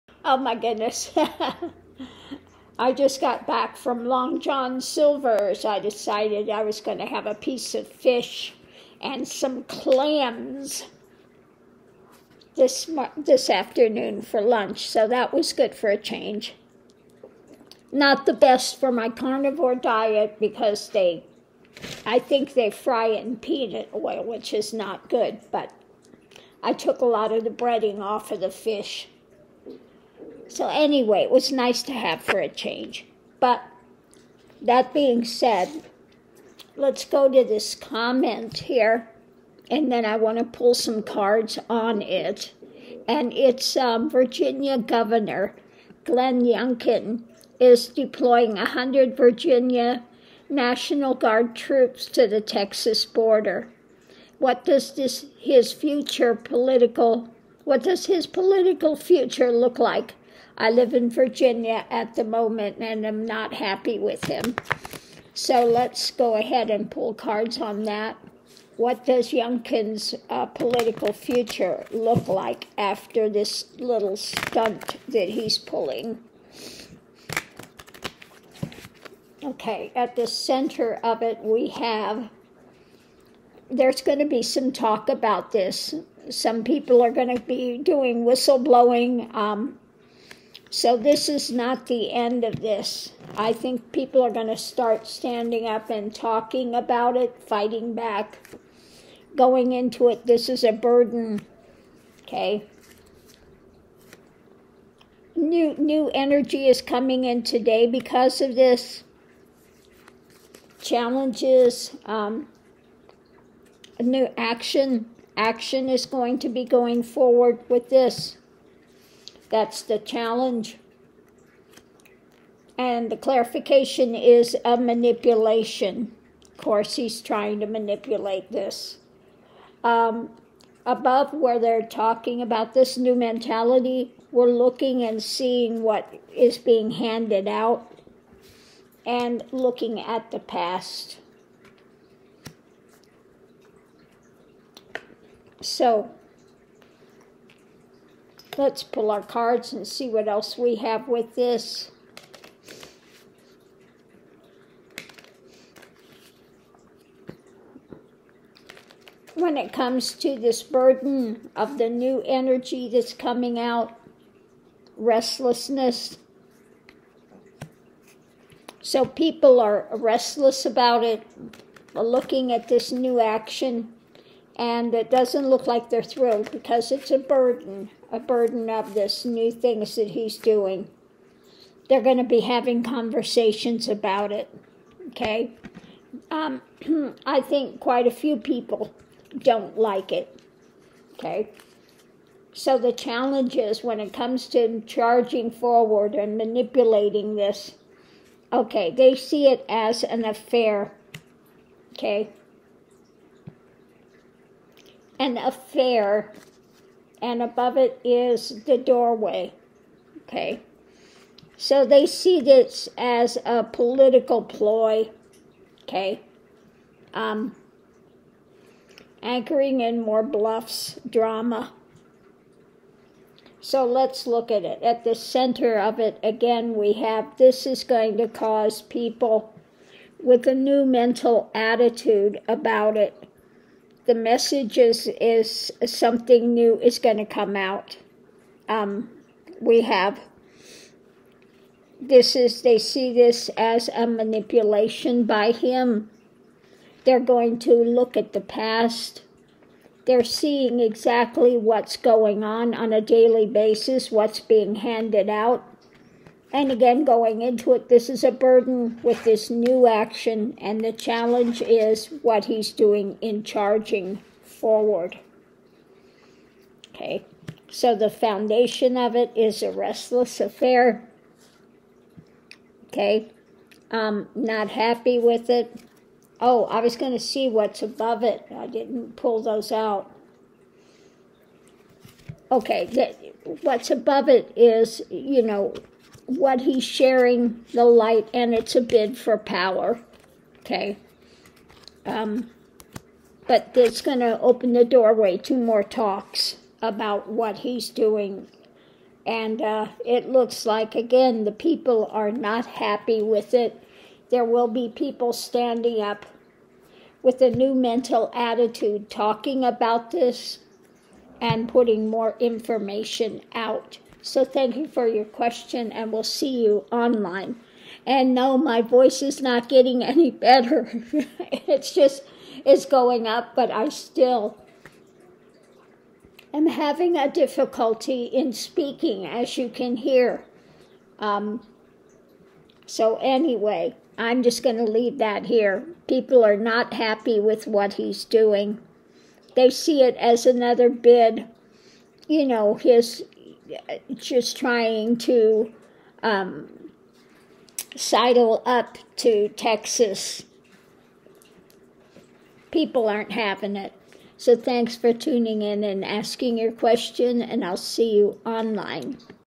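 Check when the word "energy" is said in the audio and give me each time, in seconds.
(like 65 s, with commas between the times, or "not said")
106 s, 162 s.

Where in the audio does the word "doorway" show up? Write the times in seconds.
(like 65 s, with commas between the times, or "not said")
208 s, 294 s.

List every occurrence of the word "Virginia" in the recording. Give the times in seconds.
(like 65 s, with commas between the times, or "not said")
44 s, 49 s, 61 s.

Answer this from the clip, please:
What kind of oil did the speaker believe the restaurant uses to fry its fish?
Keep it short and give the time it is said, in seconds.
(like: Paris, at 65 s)
peanut oil, at 23 s.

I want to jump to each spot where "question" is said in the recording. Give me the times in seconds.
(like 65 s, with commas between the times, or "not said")
315 s, 356 s.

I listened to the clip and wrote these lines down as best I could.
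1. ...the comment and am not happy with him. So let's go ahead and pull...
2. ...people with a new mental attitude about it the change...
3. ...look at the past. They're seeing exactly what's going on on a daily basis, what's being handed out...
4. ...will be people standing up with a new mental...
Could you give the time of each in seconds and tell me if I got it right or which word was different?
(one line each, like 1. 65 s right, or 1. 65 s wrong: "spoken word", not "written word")
1. 62 s wrong: "moment", not "comment"
2. 228 s wrong: "message", not "change"
3. 247 s right
4. 304 s right.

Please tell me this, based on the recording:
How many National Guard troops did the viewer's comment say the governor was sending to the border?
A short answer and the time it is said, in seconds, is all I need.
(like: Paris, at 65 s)
100, at 48 s.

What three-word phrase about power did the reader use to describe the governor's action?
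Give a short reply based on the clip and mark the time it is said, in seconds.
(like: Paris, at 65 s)
a bid for power, at 288 s.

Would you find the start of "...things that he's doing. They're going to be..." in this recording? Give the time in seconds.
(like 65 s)
179 s.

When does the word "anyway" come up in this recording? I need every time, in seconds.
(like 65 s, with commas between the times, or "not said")
30 s, 333 s.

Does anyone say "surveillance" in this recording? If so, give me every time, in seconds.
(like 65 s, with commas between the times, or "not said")
not said.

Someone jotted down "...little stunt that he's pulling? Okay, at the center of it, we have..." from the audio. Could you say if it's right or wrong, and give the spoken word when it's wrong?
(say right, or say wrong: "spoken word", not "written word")
right.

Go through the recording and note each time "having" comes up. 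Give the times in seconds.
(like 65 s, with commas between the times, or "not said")
182 s, 326 s, 353 s.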